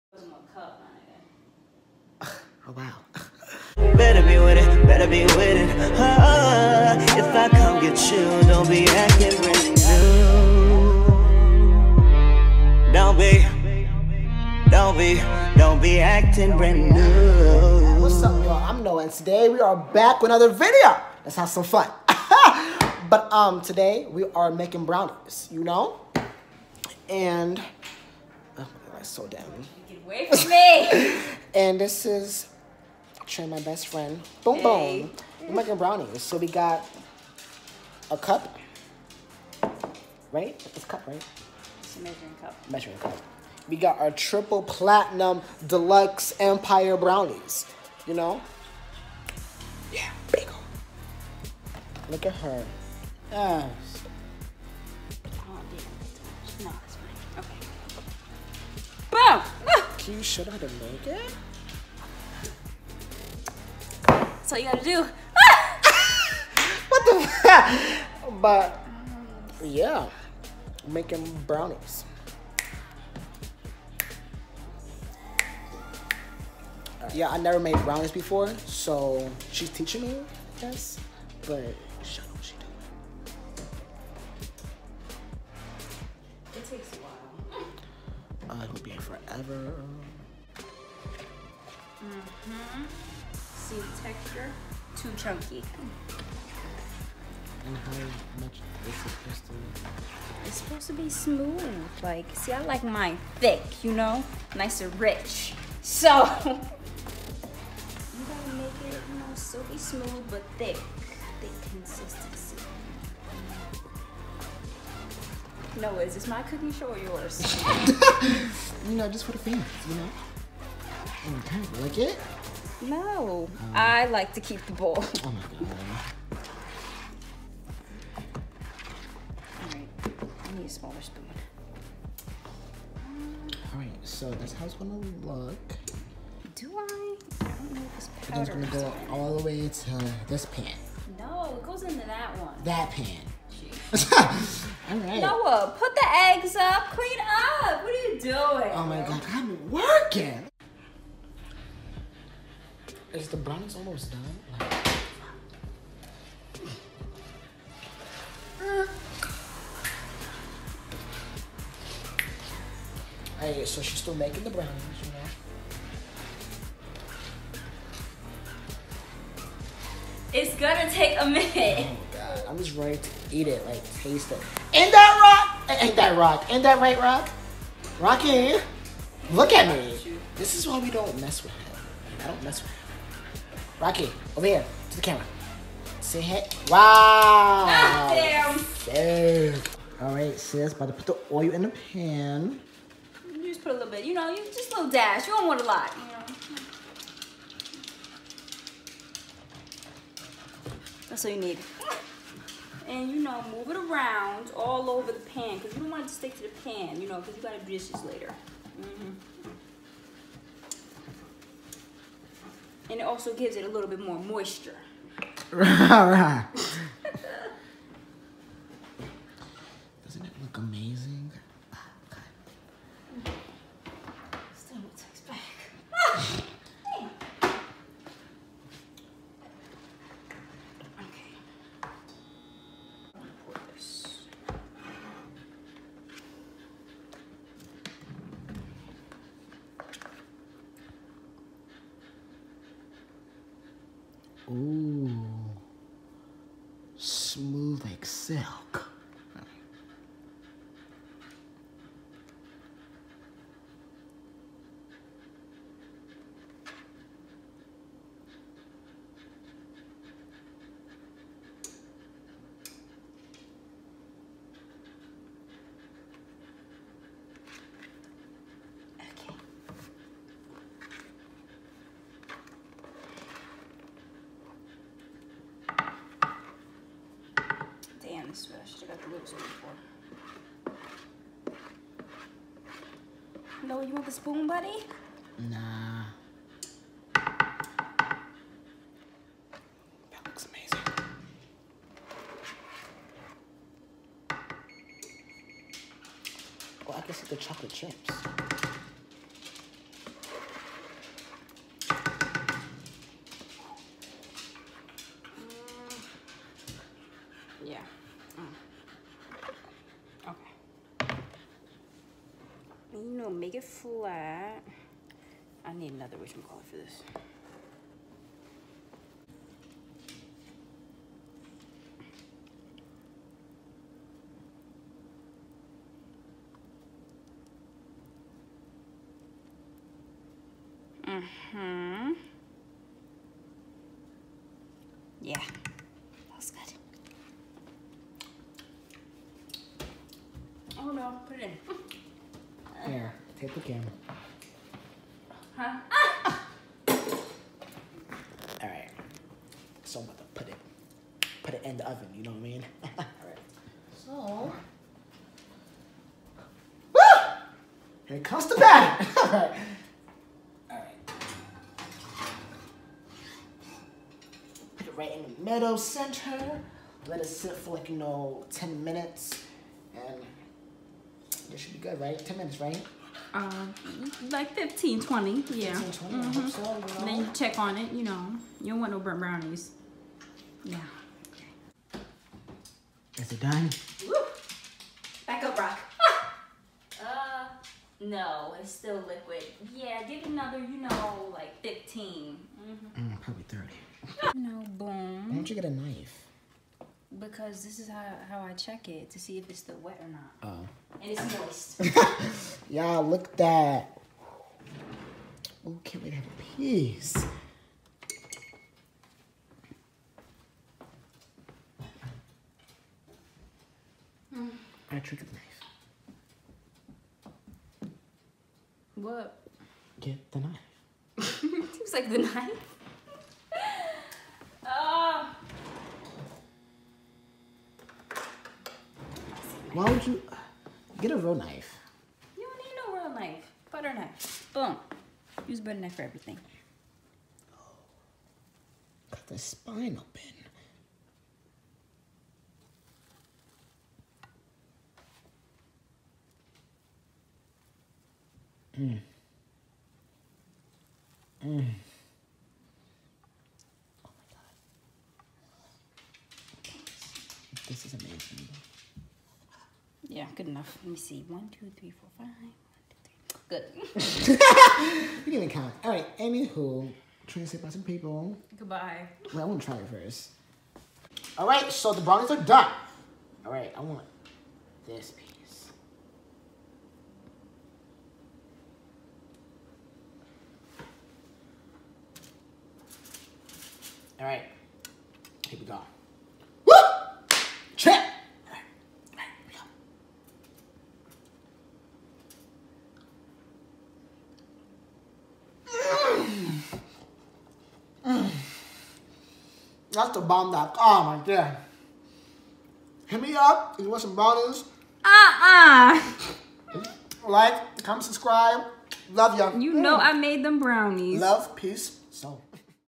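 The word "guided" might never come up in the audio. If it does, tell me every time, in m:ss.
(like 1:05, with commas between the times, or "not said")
not said.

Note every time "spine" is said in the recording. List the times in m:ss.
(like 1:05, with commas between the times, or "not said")
7:19.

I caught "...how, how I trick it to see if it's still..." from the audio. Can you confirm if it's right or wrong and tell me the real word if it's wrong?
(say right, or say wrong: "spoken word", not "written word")
wrong: "check", not "trick".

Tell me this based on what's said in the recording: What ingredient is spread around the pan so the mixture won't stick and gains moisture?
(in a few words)
oil.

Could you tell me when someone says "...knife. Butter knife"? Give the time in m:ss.
7:13.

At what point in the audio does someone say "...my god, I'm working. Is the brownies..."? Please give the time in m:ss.
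2:28.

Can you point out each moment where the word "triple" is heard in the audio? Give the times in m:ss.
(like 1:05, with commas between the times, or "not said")
0:44.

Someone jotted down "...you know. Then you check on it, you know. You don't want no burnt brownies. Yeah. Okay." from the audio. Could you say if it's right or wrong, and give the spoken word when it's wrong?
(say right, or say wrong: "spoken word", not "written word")
right.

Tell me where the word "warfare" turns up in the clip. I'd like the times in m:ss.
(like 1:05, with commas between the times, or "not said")
not said.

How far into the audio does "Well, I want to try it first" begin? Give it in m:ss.
7:49.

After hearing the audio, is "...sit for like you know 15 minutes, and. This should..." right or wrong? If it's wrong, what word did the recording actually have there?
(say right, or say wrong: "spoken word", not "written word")
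wrong: "10", not "15".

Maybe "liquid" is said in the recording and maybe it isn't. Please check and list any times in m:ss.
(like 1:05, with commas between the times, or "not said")
6:29.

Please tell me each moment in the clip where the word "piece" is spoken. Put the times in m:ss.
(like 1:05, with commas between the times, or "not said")
6:46, 7:55.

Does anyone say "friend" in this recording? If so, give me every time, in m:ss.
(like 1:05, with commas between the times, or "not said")
0:33.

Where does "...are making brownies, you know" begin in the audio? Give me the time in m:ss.
0:24.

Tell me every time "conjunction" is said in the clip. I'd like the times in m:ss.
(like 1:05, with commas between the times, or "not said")
not said.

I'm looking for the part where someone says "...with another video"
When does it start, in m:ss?
0:20.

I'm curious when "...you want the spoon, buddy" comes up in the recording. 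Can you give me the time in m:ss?
4:43.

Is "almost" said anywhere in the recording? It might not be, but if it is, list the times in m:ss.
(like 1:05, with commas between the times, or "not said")
2:33.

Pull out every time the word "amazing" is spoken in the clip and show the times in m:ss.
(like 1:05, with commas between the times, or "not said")
4:50, 7:37.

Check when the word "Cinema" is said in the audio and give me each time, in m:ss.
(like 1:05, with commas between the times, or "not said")
not said.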